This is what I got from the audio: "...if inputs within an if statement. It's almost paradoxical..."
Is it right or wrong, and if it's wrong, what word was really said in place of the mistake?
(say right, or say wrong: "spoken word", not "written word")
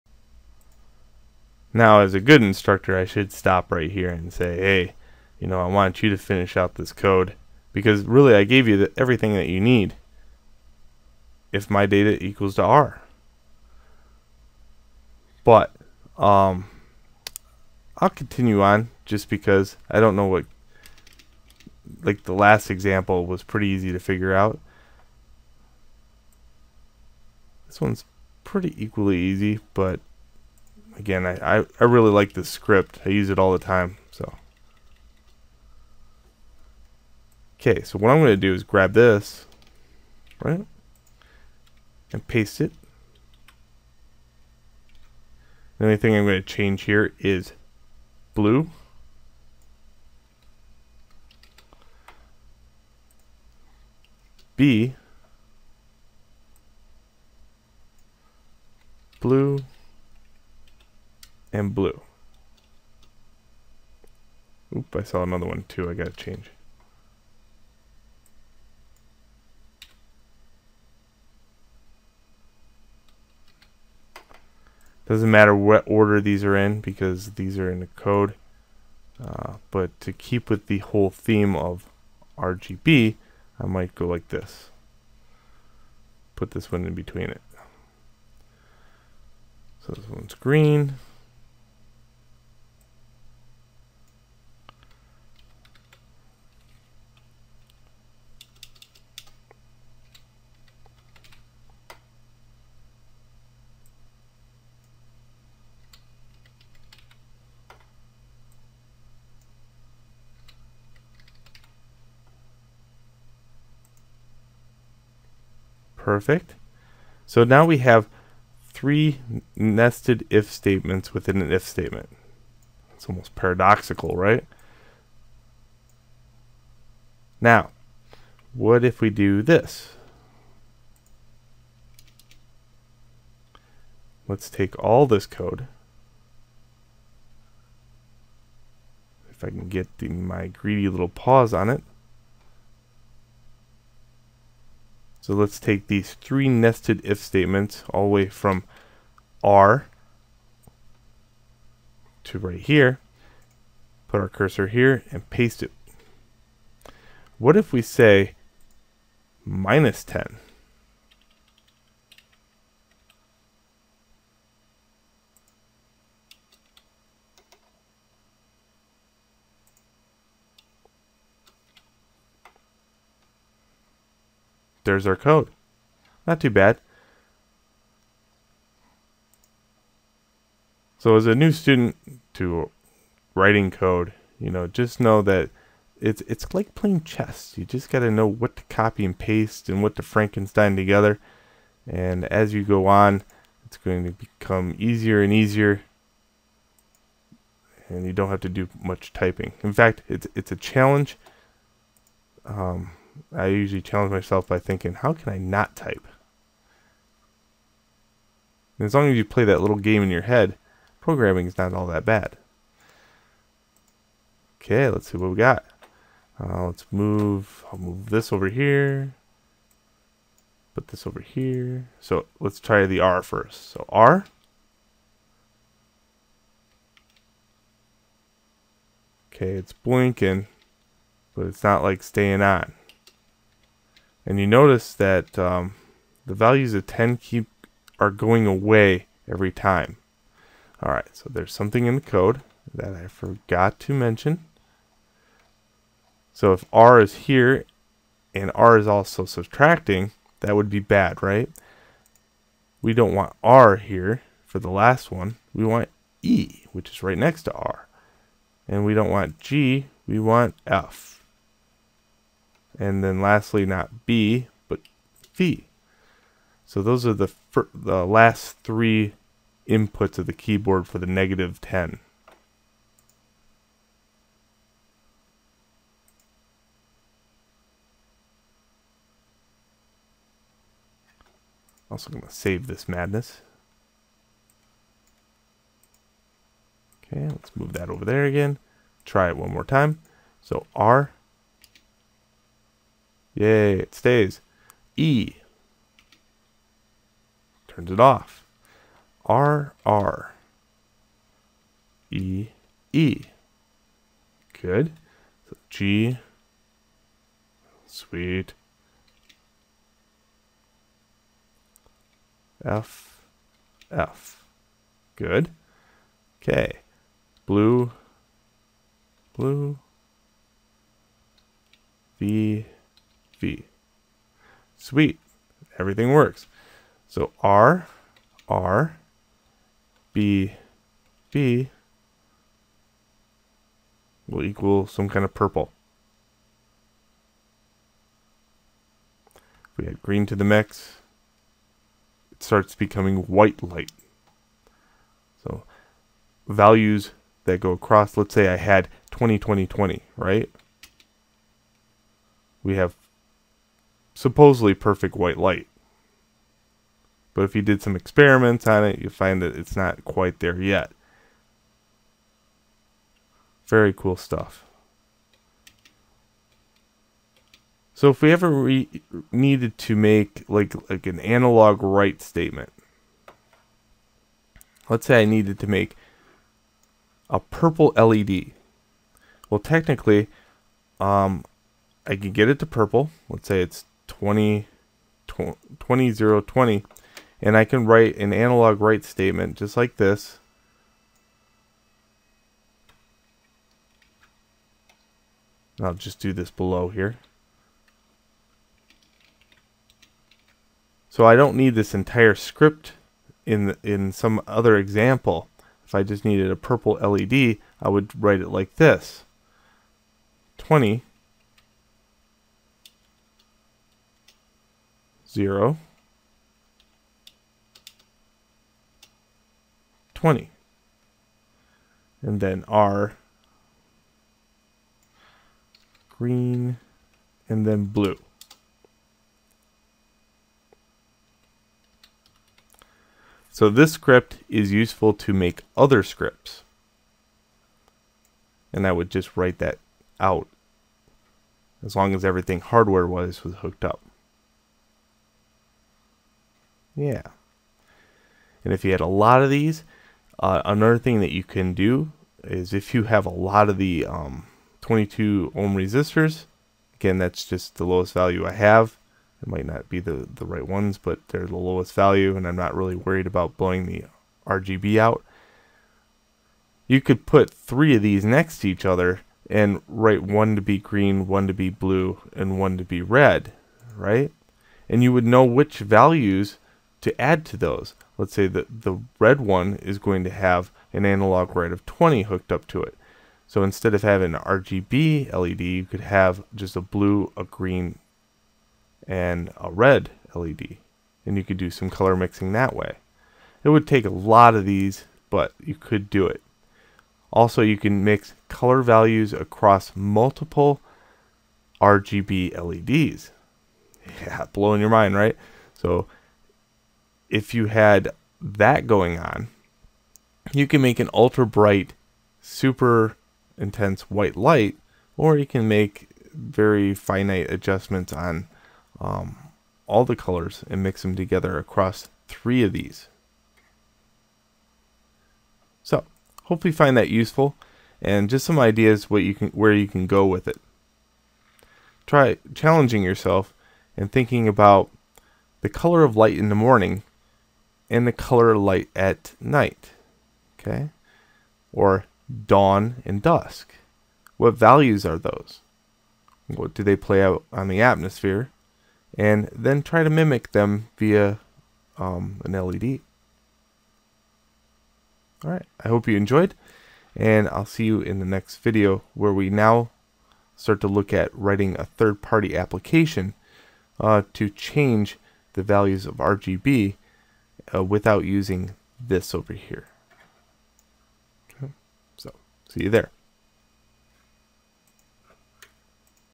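wrong: "statements", not "inputs".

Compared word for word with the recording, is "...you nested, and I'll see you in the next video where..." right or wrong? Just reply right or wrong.
wrong.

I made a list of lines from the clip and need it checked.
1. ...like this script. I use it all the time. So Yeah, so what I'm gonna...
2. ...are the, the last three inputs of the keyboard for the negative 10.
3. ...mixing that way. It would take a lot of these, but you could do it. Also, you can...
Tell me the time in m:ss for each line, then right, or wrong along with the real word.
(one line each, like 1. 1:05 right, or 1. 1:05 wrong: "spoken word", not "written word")
1. 0:32 wrong: "Okay", not "Yeah"
2. 4:27 right
3. 8:12 right.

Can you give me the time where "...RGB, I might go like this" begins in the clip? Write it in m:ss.
1:22.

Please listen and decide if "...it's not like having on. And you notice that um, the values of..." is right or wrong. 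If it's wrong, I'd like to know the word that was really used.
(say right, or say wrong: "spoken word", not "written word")
wrong: "staying", not "having".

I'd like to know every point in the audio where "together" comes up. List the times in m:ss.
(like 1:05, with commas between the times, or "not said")
3:10, 8:41.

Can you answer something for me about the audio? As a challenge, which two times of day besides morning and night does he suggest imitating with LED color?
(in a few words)
dawn and dusk.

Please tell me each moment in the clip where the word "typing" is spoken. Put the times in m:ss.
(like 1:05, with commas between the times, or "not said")
3:19.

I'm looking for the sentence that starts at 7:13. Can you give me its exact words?
So this script is useful to make other scripts.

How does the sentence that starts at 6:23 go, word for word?
Let's say it's 20, 20, 20, 0, 20 and I can write an analog write statement just like this.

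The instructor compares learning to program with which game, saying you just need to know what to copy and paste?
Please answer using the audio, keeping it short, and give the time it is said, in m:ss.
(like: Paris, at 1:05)
chess, at 3:06.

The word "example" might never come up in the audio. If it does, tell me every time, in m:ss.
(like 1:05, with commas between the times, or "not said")
0:22, 6:44.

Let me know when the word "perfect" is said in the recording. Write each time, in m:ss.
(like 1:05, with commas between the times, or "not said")
1:56, 5:54.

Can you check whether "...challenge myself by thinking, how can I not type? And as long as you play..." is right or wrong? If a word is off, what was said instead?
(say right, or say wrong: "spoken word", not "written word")
right.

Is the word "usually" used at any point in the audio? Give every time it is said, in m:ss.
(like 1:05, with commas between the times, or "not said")
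3:23.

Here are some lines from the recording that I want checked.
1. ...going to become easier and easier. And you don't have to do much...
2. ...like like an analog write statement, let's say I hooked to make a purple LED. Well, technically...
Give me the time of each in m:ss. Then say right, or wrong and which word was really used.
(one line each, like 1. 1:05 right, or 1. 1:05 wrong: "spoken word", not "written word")
1. 3:13 right
2. 6:10 wrong: "needed", not "hooked".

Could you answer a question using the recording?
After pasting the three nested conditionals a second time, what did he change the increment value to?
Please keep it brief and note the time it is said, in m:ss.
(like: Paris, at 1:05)
minus 10, at 2:39.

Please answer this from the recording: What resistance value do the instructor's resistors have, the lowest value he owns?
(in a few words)
22 ohm.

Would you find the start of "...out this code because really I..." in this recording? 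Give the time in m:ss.
0:06.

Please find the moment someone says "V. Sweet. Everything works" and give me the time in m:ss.
5:23.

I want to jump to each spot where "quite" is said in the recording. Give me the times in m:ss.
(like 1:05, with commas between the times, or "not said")
6:00.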